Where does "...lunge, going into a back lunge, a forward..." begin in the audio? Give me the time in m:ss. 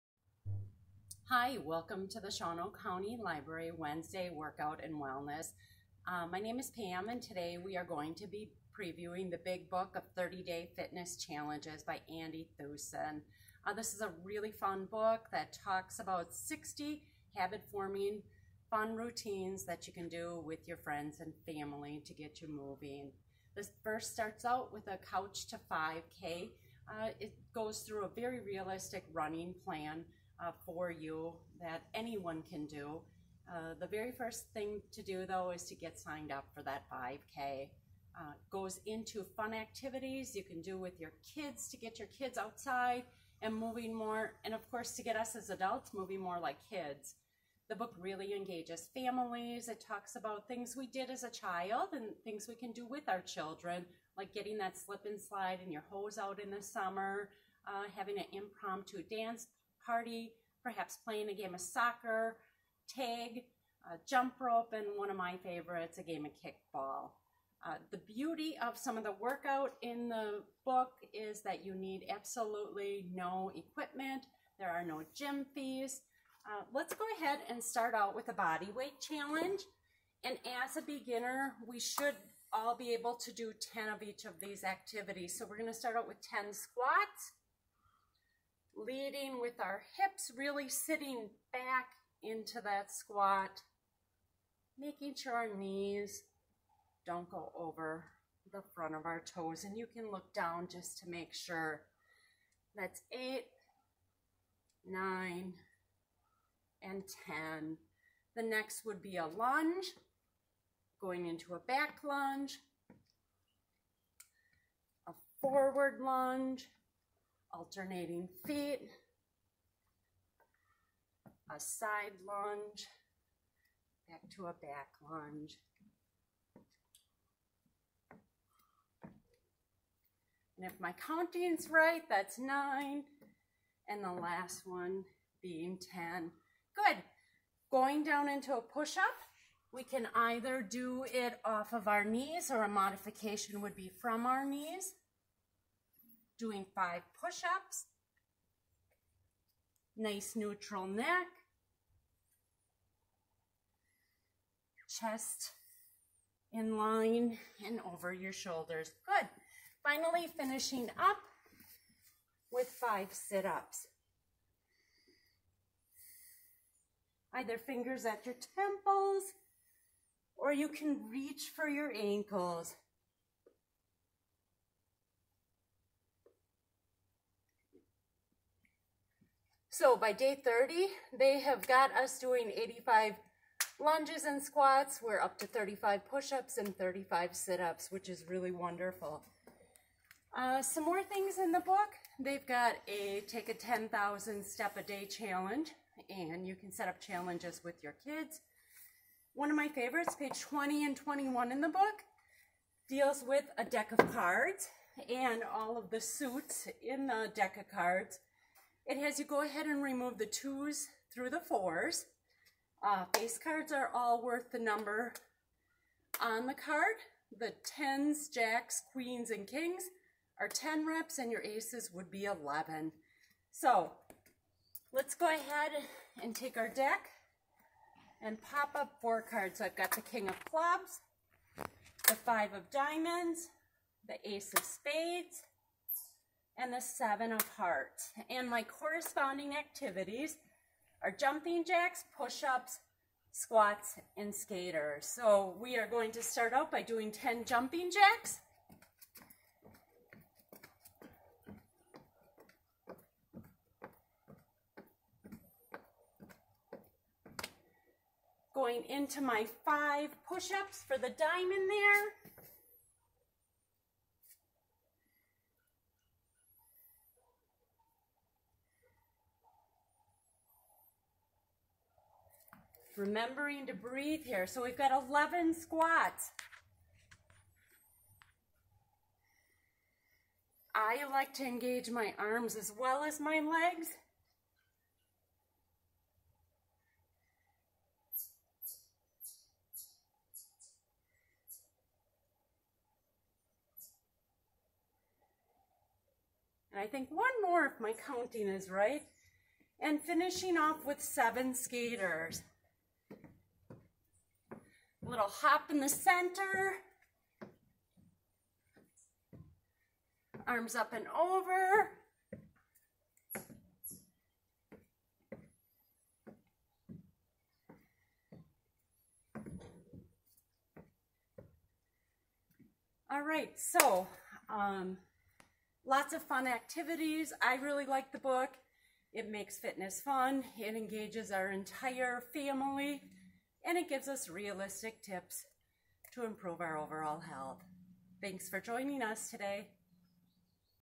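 1:49.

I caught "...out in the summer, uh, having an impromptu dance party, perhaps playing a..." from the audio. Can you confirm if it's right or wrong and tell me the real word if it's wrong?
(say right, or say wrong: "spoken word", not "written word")
right.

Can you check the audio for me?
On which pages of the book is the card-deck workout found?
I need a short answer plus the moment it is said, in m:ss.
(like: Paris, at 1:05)
20 and 21, at 3:20.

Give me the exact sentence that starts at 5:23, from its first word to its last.
All right, so um, lots of fun activities.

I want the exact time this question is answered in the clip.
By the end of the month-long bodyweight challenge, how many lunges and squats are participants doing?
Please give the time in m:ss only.
3:02.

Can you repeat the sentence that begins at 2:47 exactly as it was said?
Either fingers at your temples or you can reach for your ankles.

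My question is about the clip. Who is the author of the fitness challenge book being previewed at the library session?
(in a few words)
Andy Thusen.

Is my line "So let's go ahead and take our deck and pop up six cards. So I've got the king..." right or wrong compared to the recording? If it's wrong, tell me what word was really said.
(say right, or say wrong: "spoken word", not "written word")
wrong: "four", not "six".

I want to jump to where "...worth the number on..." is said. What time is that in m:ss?
3:34.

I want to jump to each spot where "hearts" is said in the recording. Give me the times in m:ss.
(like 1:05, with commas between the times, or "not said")
3:57.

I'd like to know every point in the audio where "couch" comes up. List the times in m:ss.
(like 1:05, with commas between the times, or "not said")
0:25.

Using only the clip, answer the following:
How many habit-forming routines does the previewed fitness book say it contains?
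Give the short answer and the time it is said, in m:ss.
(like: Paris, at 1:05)
60, at 0:16.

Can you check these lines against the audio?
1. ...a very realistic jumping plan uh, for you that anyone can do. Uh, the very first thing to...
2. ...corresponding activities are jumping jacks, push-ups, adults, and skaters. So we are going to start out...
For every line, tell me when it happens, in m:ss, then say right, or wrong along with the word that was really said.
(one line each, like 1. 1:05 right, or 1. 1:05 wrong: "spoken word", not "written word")
1. 0:28 wrong: "running", not "jumping"
2. 3:58 wrong: "squats", not "adults".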